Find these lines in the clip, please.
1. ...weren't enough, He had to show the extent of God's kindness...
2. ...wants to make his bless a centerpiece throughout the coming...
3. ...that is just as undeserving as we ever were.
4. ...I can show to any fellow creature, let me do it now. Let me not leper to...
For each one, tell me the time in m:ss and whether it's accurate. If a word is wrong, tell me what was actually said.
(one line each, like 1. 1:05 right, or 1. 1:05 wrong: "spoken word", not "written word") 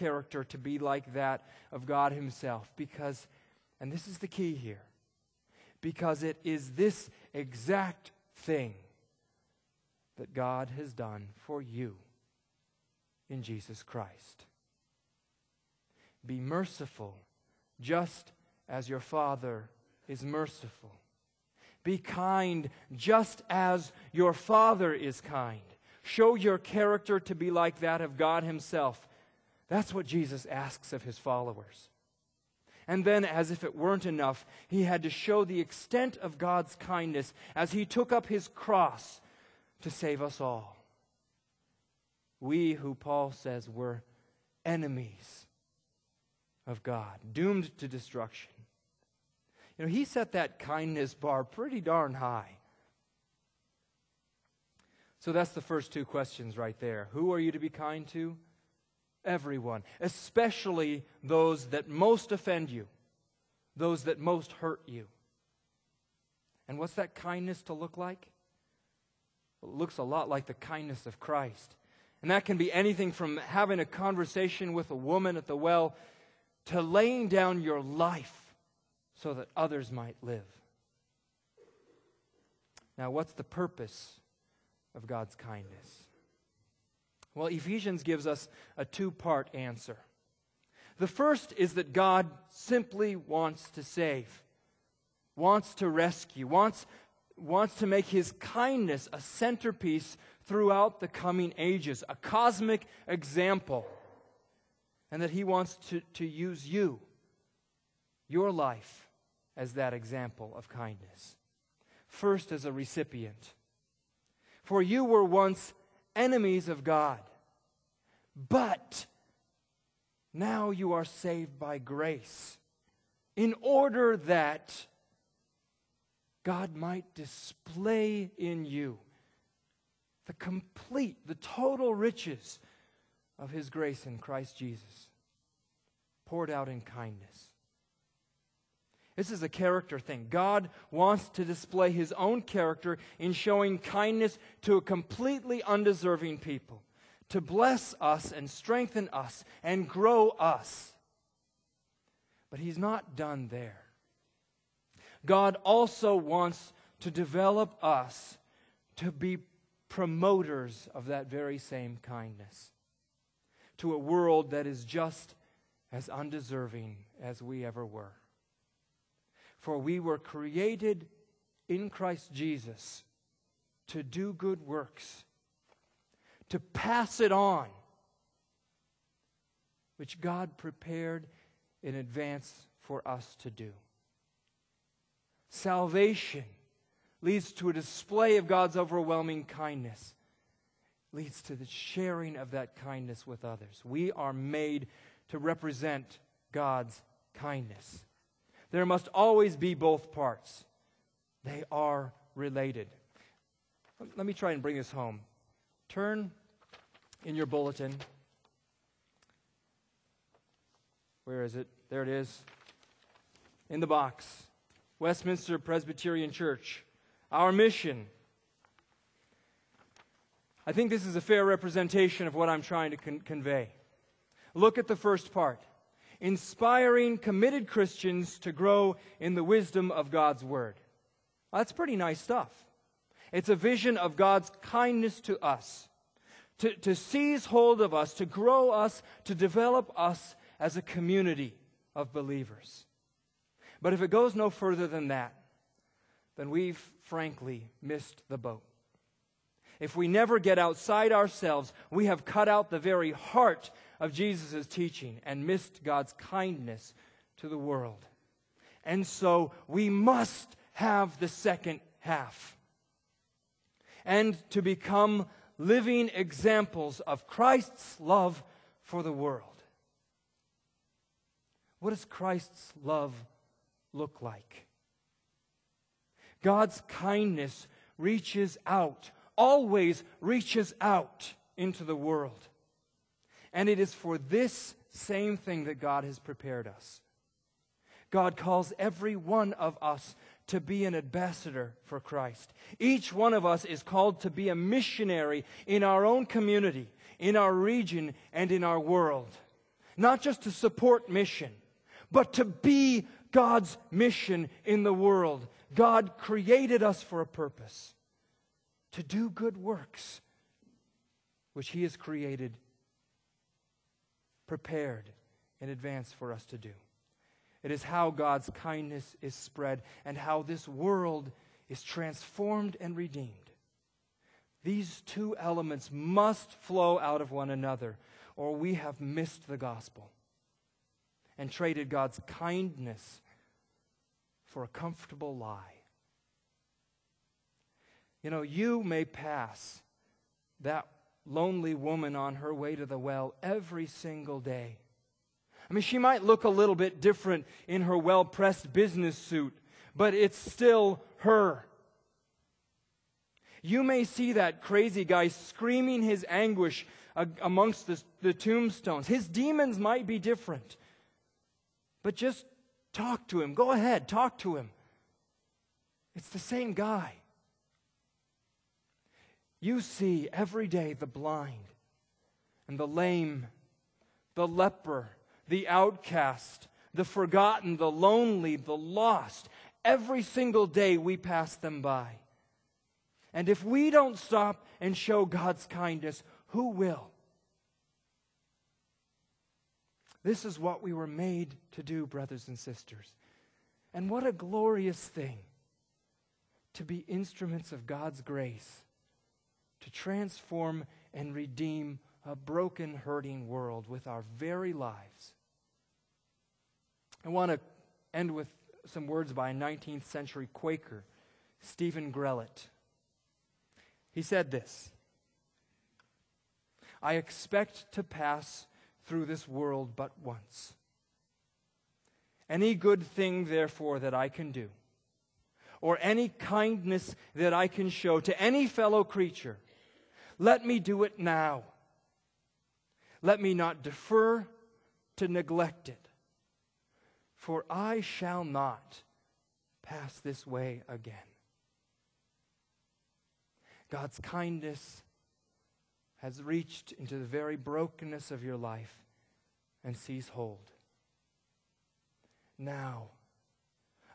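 1. 0:33 right
2. 1:37 wrong: "kindness", not "bless"
3. 2:44 right
4. 7:07 wrong: "defer", not "leper".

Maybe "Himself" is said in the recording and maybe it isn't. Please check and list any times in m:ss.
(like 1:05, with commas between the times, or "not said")
0:02, 0:28.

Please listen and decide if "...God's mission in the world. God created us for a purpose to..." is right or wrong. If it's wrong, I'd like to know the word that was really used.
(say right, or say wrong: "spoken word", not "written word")
right.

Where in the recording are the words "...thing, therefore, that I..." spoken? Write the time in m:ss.
7:03.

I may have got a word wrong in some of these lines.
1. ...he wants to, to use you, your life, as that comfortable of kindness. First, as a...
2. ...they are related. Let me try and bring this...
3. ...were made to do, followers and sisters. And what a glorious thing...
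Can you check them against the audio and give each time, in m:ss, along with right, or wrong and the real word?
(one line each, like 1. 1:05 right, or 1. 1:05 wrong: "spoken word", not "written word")
1. 1:45 wrong: "example", not "comfortable"
2. 3:21 right
3. 6:30 wrong: "brothers", not "followers".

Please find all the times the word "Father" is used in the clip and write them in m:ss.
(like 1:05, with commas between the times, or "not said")
0:18, 0:24.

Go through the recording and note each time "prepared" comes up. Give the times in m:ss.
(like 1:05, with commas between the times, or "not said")
3:00, 4:46, 5:14.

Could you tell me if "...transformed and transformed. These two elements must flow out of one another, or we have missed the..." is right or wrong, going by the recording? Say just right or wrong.
wrong.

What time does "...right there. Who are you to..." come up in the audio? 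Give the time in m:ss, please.
0:56.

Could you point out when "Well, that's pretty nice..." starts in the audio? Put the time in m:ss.
3:51.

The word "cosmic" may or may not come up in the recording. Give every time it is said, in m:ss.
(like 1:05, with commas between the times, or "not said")
1:42.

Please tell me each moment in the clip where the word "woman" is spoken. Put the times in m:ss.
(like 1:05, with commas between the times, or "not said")
1:14, 5:41.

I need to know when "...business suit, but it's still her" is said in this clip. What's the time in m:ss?
5:48.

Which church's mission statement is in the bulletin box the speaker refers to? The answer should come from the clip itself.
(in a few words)
Westminster Presbyterian Church.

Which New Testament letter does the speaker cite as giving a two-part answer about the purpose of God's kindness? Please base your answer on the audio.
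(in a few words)
Ephesians.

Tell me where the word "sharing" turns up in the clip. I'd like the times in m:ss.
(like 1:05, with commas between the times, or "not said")
3:11.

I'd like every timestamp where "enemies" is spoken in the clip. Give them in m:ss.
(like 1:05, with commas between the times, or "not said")
0:44, 1:56.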